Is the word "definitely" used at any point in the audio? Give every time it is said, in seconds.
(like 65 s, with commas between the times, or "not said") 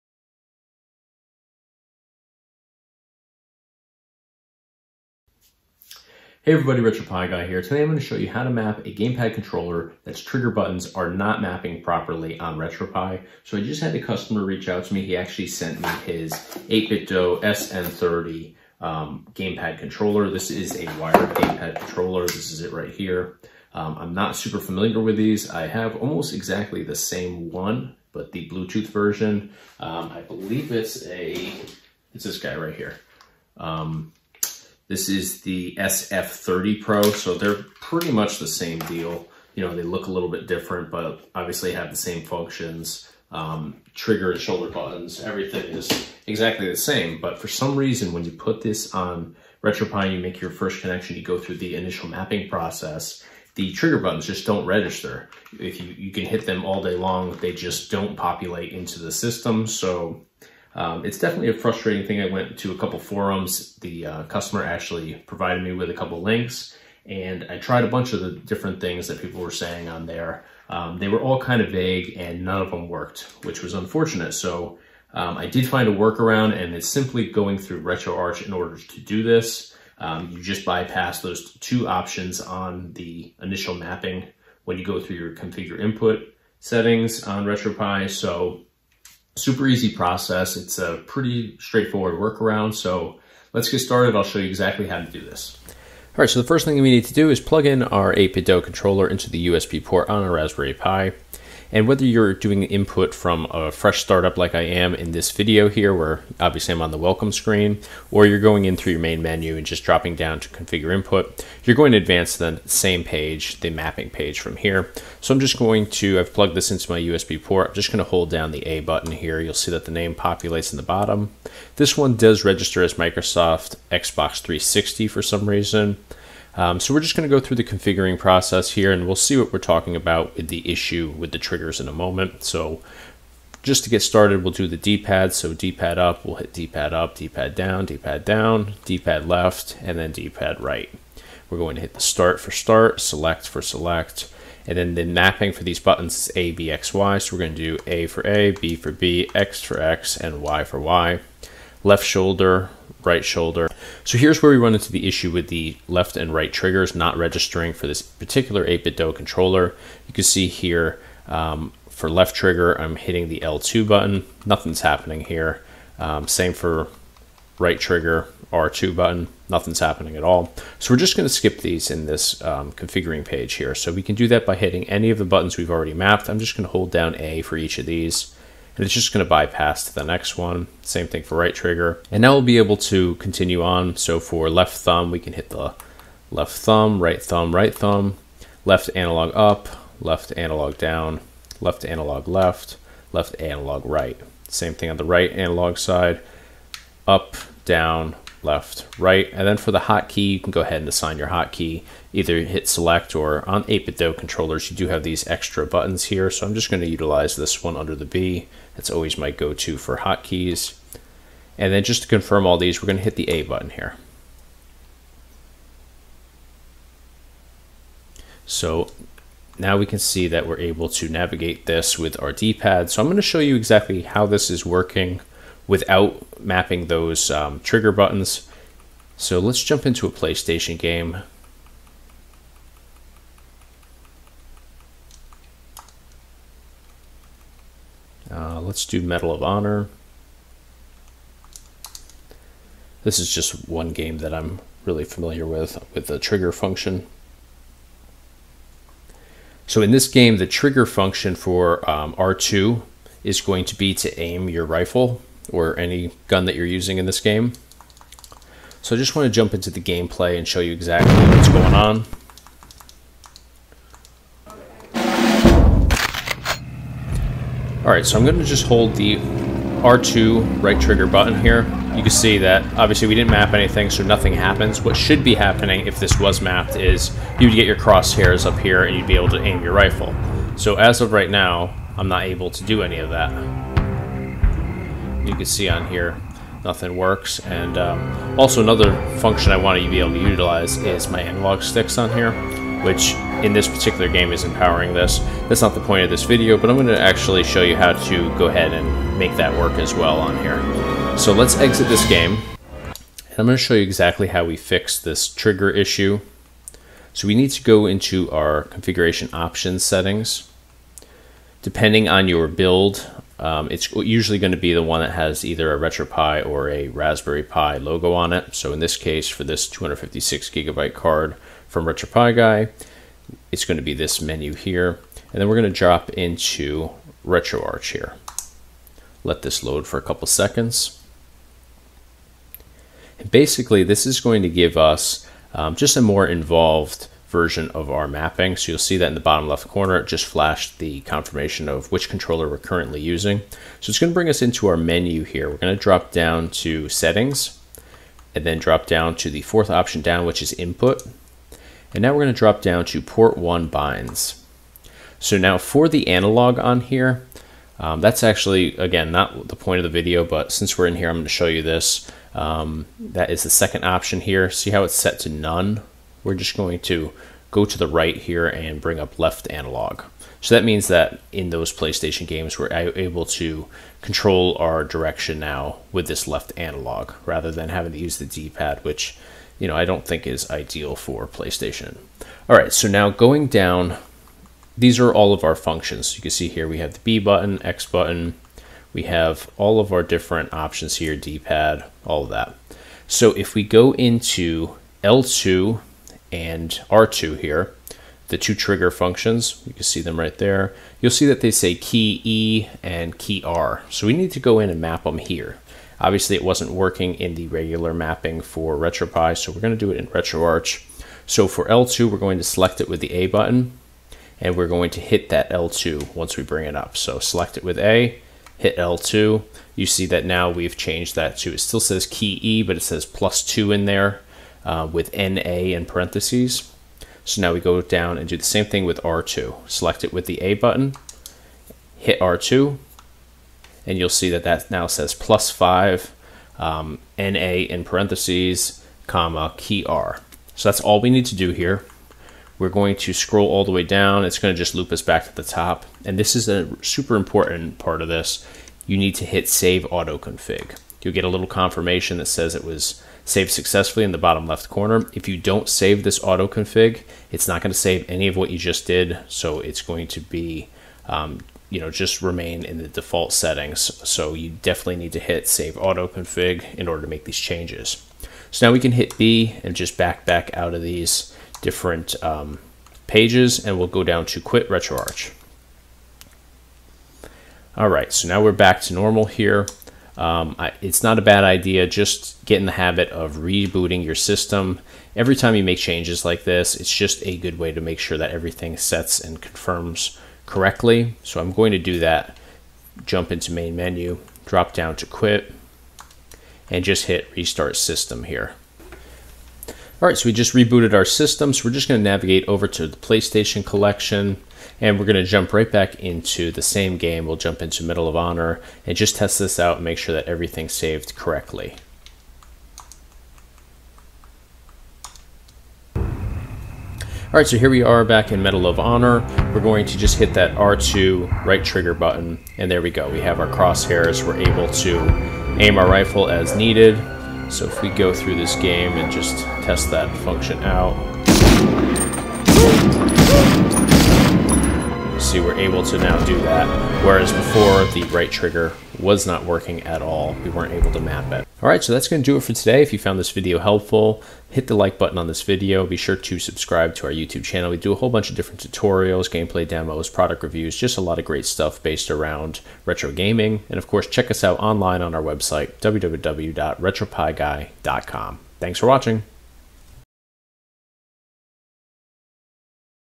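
61 s, 464 s.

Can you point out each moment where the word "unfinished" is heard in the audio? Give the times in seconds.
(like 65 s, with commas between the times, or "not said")
not said.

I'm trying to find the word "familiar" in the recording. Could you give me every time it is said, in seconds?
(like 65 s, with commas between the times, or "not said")
24 s, 245 s.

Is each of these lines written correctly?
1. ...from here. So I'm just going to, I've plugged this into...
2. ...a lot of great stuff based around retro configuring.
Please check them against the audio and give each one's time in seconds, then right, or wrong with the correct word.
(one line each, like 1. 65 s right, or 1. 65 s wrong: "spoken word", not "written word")
1. 114 s right
2. 550 s wrong: "gaming", not "configuring".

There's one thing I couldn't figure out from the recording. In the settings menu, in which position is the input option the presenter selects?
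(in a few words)
Fourth.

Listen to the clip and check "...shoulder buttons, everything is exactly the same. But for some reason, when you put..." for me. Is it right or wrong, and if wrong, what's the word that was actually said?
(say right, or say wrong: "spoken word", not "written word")
right.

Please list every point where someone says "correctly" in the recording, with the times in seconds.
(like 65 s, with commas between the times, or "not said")
490 s, 511 s.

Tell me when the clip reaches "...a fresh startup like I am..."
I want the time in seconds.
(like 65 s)
103 s.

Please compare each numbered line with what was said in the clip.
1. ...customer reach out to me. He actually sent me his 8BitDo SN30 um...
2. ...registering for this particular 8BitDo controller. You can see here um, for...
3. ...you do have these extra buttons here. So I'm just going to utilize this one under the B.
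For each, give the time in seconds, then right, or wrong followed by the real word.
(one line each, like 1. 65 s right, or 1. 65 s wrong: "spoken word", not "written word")
1. 14 s right
2. 157 s right
3. 204 s right.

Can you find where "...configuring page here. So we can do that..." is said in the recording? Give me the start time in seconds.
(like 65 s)
172 s.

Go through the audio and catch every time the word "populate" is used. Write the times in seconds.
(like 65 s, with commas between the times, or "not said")
58 s, 120 s.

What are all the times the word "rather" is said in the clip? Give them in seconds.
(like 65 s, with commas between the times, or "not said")
377 s.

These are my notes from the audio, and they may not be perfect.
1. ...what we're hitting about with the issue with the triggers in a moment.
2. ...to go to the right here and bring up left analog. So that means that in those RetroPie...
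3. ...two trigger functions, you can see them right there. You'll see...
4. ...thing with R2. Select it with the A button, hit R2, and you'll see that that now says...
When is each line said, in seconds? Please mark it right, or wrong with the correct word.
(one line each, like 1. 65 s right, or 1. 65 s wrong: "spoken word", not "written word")
1. 129 s wrong: "talking", not "hitting"
2. 366 s wrong: "PlayStation", not "RetroPie"
3. 398 s right
4. 428 s right.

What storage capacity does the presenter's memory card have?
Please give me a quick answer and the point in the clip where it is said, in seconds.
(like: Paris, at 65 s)
256 gigabytes, at 319 s.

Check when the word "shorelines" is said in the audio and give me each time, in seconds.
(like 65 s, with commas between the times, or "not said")
not said.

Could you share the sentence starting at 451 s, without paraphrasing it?
You'll get a little confirmation that says it was Save successfully in the bottom left corner.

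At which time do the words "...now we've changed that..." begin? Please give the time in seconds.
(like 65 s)
420 s.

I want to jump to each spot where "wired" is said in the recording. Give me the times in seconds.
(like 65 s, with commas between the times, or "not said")
20 s.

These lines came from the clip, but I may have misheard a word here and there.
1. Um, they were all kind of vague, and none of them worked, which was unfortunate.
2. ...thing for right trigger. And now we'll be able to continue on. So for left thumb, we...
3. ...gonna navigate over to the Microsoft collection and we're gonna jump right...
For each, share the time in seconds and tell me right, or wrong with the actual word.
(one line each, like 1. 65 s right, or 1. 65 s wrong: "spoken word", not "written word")
1. 70 s right
2. 181 s right
3. 501 s wrong: "PlayStation", not "Microsoft".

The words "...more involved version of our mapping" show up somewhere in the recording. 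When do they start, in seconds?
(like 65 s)
336 s.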